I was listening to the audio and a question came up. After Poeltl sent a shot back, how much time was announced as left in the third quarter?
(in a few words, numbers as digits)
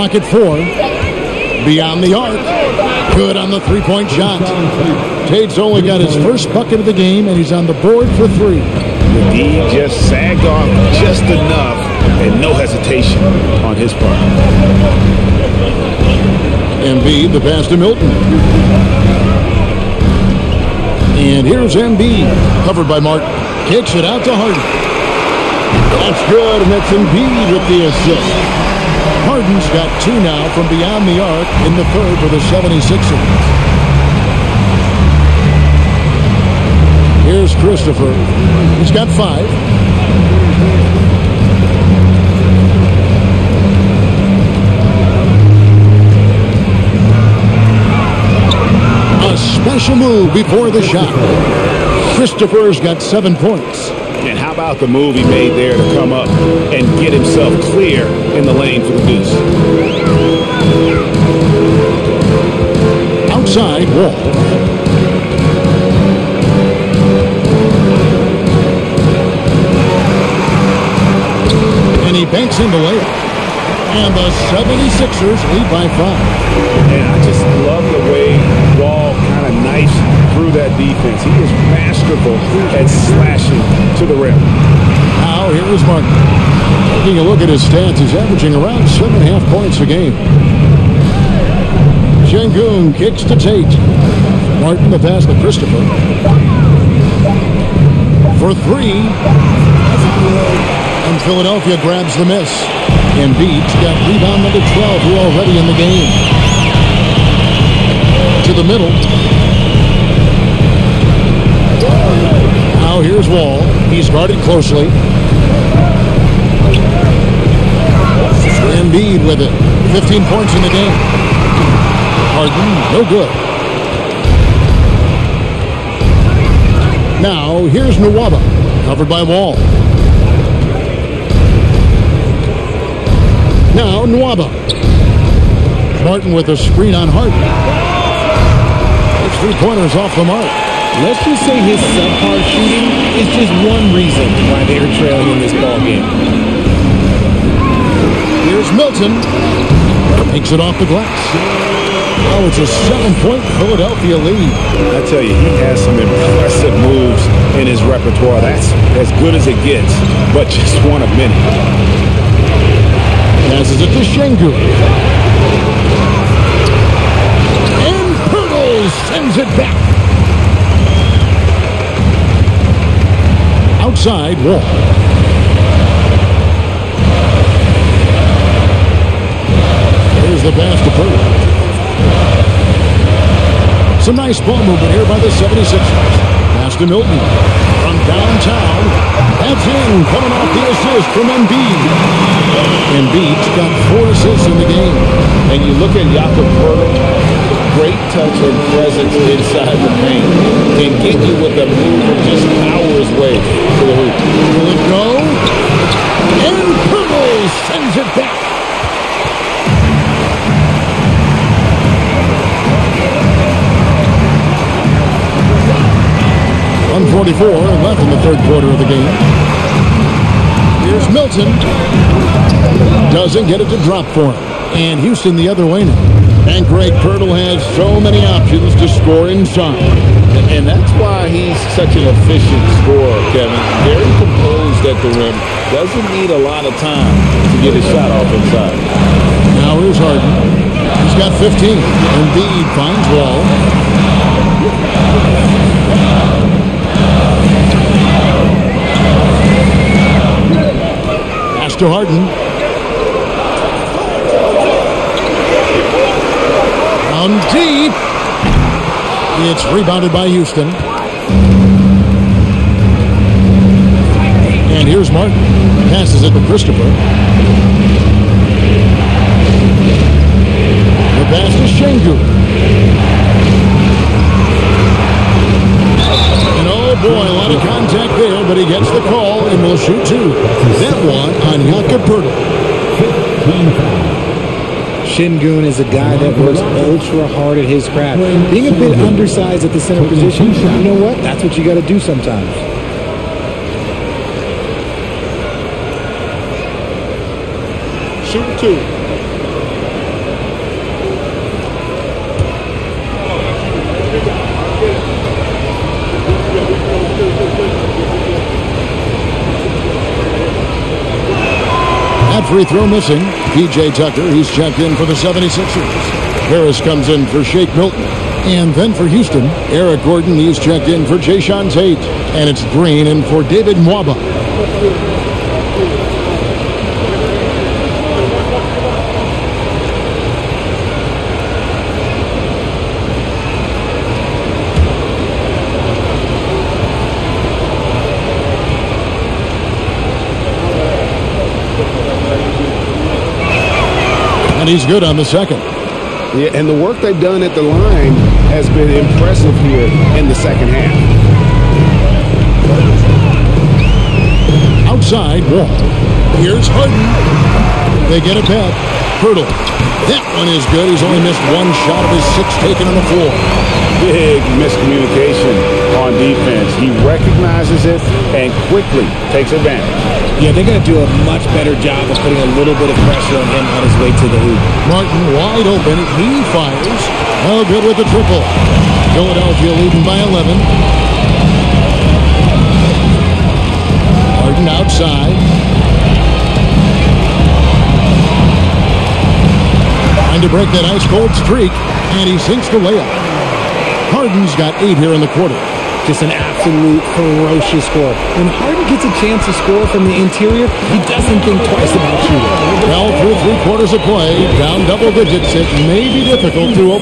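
1:44.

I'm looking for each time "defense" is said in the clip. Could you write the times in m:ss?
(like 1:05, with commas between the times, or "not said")
1:20, 6:06.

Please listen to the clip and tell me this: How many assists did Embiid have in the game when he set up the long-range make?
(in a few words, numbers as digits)
4.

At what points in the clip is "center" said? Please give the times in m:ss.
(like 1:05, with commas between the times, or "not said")
4:49.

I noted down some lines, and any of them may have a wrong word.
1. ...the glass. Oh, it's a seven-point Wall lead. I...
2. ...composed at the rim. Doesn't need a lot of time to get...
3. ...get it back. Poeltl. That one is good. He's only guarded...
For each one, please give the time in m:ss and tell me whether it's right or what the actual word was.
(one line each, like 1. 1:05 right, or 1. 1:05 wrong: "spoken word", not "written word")
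1. 2:30 wrong: "Philadelphia", not "Wall"
2. 3:54 right
3. 5:58 wrong: "missed", not "guarded".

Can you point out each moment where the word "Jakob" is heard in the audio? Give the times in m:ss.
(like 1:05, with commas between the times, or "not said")
3:16, 4:41.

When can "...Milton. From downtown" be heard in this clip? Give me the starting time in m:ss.
3:06.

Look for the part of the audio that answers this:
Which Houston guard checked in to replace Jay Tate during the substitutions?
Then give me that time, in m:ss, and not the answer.
5:19.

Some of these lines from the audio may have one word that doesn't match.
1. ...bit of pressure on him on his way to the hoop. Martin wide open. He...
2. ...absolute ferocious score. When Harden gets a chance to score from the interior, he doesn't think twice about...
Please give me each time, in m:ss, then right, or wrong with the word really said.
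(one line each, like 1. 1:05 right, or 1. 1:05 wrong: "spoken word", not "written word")
1. 6:12 right
2. 6:36 right.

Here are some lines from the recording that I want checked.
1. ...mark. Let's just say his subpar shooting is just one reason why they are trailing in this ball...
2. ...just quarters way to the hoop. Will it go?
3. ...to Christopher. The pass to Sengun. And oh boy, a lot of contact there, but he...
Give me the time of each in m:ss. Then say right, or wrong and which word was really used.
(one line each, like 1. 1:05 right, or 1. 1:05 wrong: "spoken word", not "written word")
1. 2:20 right
2. 3:22 wrong: "powers", not "quarters"
3. 4:26 right.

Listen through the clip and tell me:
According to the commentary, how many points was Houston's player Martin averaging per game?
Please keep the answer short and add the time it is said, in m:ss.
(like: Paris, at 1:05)
7.5, at 1:28.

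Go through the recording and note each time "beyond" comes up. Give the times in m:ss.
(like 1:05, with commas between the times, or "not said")
0:01, 0:30.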